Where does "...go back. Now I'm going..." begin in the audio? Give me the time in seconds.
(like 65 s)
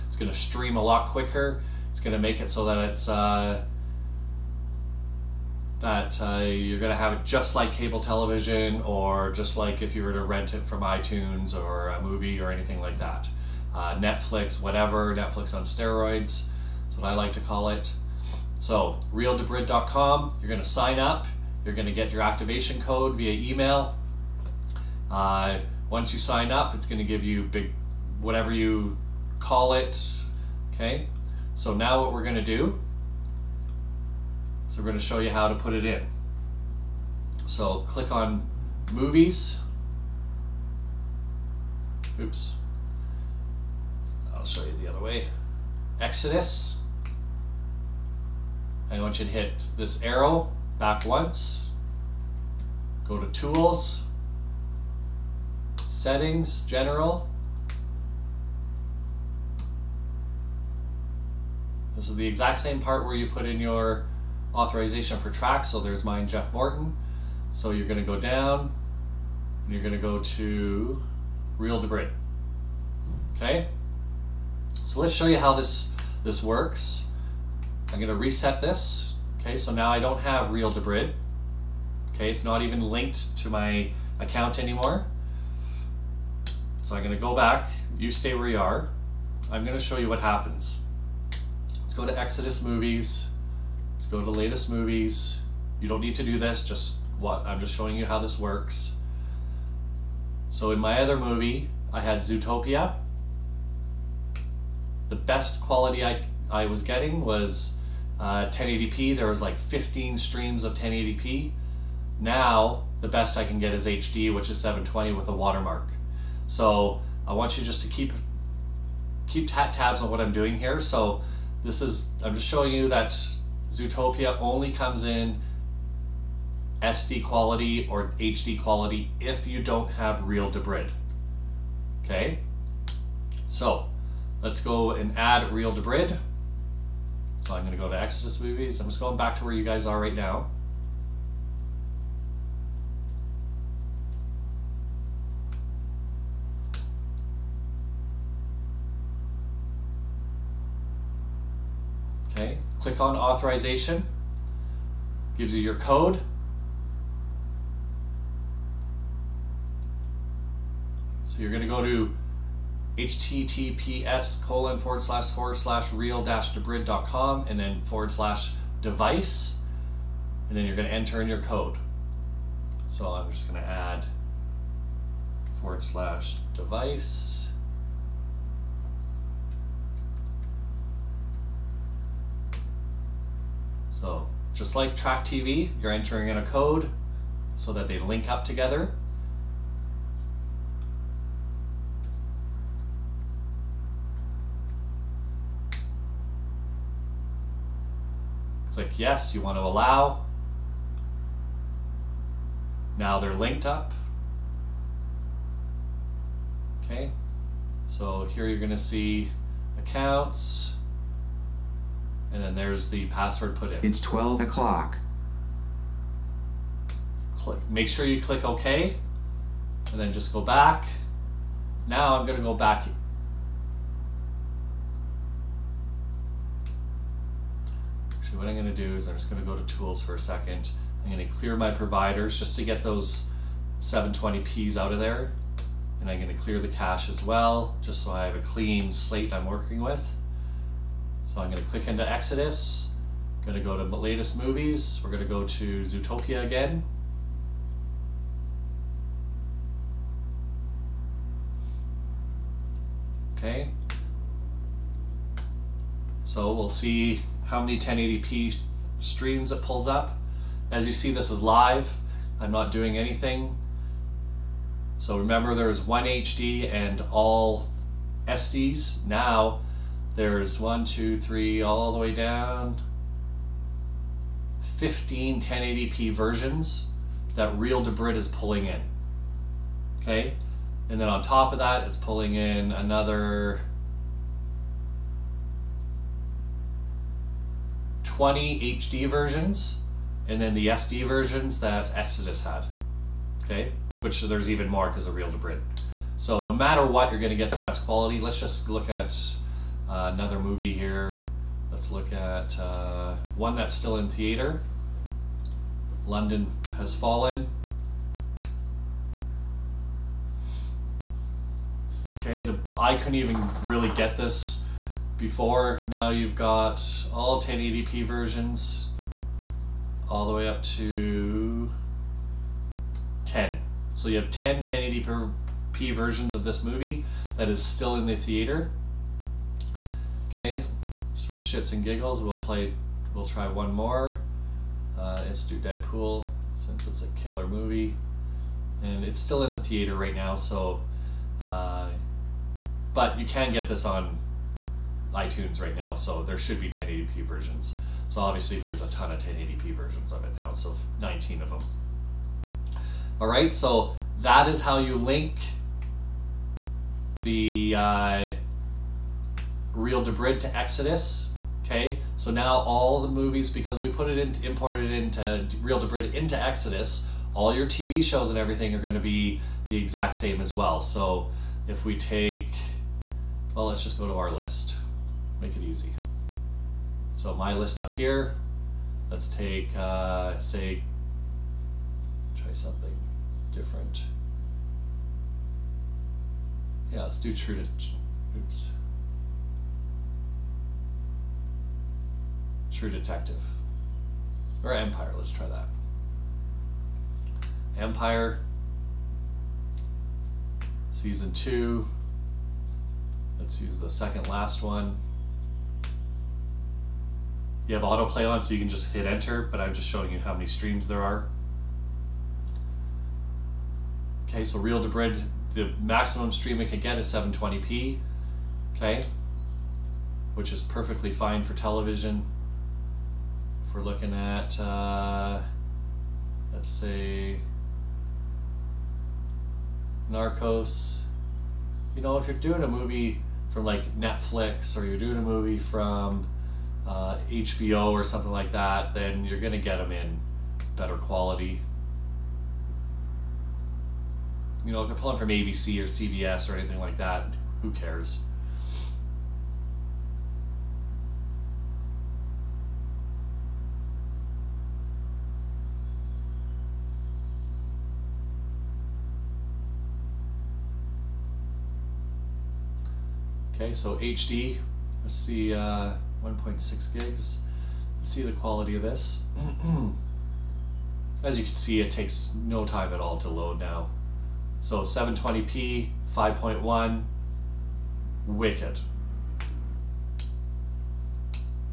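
220 s.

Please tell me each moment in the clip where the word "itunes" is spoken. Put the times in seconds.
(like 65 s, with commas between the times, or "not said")
10 s, 345 s.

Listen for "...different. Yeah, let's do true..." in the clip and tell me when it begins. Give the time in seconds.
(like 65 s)
383 s.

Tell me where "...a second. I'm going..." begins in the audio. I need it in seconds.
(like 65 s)
230 s.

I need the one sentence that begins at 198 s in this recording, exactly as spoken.
Click yes, you want to allow.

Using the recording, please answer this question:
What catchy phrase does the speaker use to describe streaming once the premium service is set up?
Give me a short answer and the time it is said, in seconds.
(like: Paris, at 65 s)
Netflix on steroids, at 15 s.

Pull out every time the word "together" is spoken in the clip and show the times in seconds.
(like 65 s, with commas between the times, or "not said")
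188 s.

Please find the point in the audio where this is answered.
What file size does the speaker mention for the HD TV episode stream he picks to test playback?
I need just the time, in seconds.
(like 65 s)
466 s.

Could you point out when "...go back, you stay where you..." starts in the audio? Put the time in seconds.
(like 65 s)
87 s.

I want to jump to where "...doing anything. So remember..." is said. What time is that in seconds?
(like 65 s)
262 s.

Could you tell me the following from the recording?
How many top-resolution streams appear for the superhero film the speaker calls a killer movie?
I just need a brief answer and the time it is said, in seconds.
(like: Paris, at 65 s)
19, at 351 s.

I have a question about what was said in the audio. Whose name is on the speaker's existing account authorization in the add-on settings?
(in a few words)
Jeff Morton.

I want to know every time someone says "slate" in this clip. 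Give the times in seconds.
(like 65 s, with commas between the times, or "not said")
238 s.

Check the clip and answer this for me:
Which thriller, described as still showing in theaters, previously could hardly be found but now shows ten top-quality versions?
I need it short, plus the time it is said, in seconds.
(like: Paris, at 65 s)
London Has Fallen, at 306 s.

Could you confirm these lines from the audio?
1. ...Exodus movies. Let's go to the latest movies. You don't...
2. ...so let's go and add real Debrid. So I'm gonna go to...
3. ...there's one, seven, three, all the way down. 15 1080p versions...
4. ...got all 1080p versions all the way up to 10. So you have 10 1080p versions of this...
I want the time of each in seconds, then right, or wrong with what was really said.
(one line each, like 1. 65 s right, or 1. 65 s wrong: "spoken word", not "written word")
1. 92 s right
2. 133 s right
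3. 270 s wrong: "two", not "seven"
4. 316 s right.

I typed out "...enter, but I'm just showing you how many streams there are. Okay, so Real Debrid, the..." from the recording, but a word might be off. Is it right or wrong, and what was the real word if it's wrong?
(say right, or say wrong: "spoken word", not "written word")
right.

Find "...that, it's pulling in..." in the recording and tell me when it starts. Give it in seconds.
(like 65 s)
281 s.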